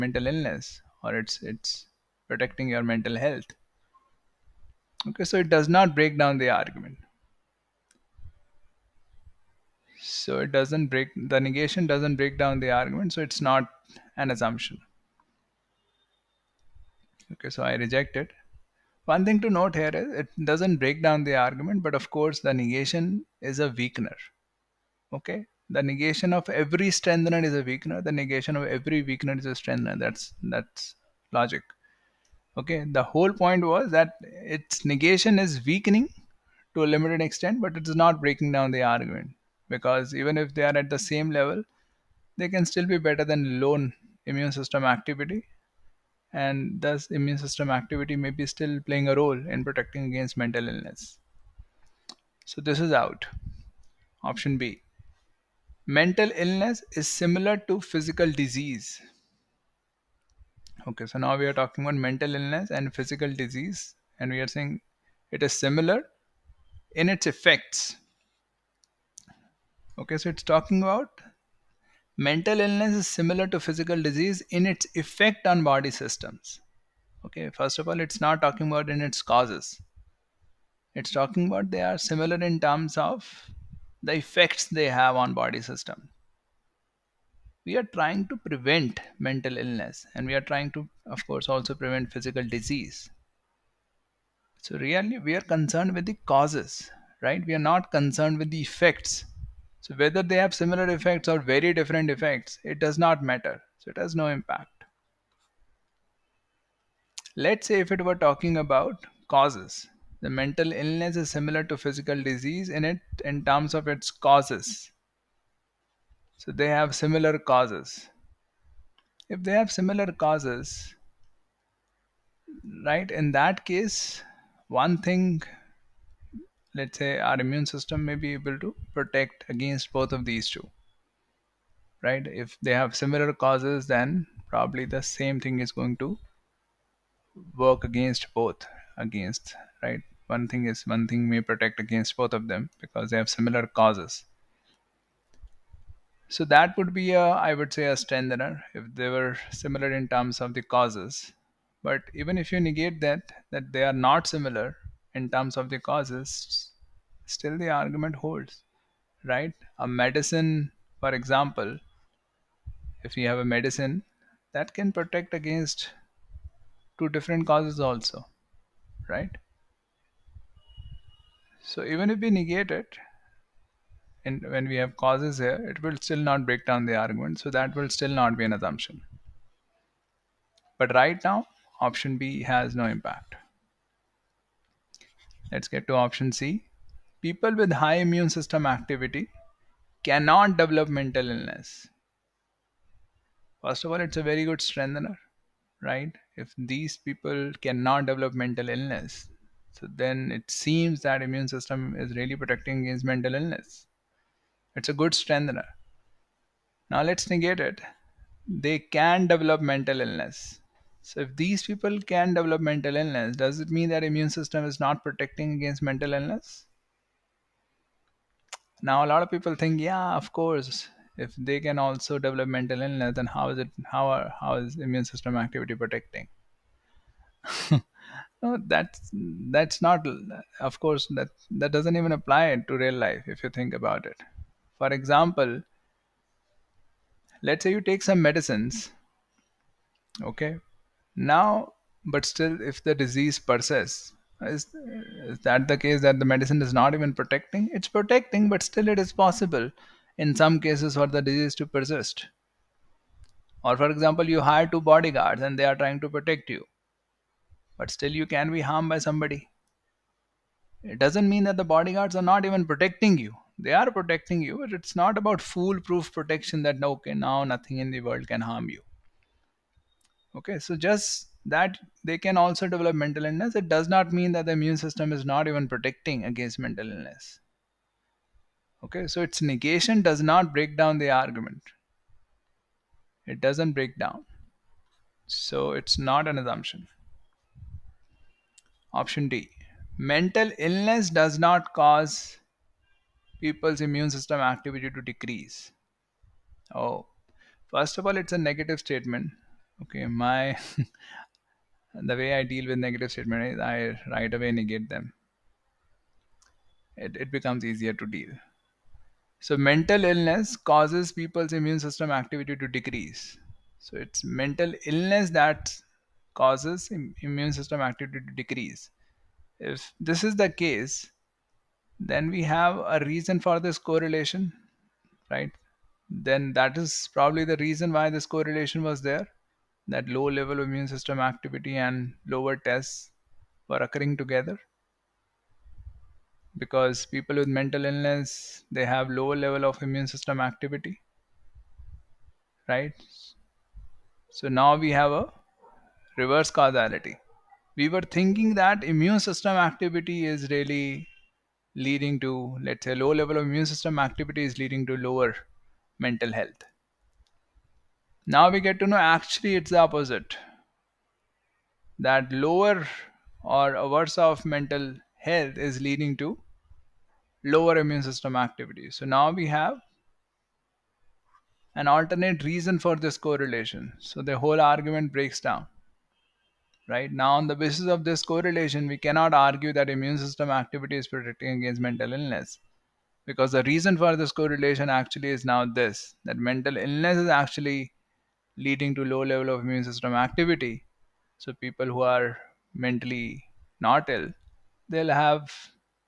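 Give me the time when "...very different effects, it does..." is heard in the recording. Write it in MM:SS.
01:41.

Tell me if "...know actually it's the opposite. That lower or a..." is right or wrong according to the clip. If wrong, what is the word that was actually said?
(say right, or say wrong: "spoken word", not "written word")
right.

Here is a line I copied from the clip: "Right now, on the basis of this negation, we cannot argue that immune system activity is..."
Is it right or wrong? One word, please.
wrong.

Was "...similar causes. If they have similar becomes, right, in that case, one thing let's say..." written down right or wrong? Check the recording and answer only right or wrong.
wrong.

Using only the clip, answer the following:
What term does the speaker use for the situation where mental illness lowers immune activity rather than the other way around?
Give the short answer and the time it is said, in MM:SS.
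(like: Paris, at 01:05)
Reverse causality, at 05:46.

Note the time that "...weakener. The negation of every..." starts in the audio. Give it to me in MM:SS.
00:27.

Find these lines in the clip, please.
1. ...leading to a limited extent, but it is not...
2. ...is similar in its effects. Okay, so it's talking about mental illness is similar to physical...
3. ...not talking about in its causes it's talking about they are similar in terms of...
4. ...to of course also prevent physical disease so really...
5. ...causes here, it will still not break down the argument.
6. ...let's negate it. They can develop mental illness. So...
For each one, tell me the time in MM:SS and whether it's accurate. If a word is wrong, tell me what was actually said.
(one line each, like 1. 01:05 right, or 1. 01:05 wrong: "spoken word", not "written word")
1. 00:35 wrong: "weakening", not "leading"
2. 01:05 right
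3. 01:18 right
4. 01:30 right
5. 02:54 right
6. 03:27 right.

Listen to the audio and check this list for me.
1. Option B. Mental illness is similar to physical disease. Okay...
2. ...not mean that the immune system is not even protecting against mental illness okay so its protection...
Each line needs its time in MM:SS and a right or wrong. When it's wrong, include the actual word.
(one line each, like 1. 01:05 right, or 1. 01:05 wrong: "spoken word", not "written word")
1. 00:54 right
2. 04:33 wrong: "negation", not "protection".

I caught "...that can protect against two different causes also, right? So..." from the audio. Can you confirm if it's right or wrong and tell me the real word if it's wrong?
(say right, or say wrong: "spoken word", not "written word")
right.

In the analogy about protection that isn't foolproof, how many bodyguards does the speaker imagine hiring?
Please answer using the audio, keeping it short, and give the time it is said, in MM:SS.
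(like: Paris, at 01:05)
2, at 04:14.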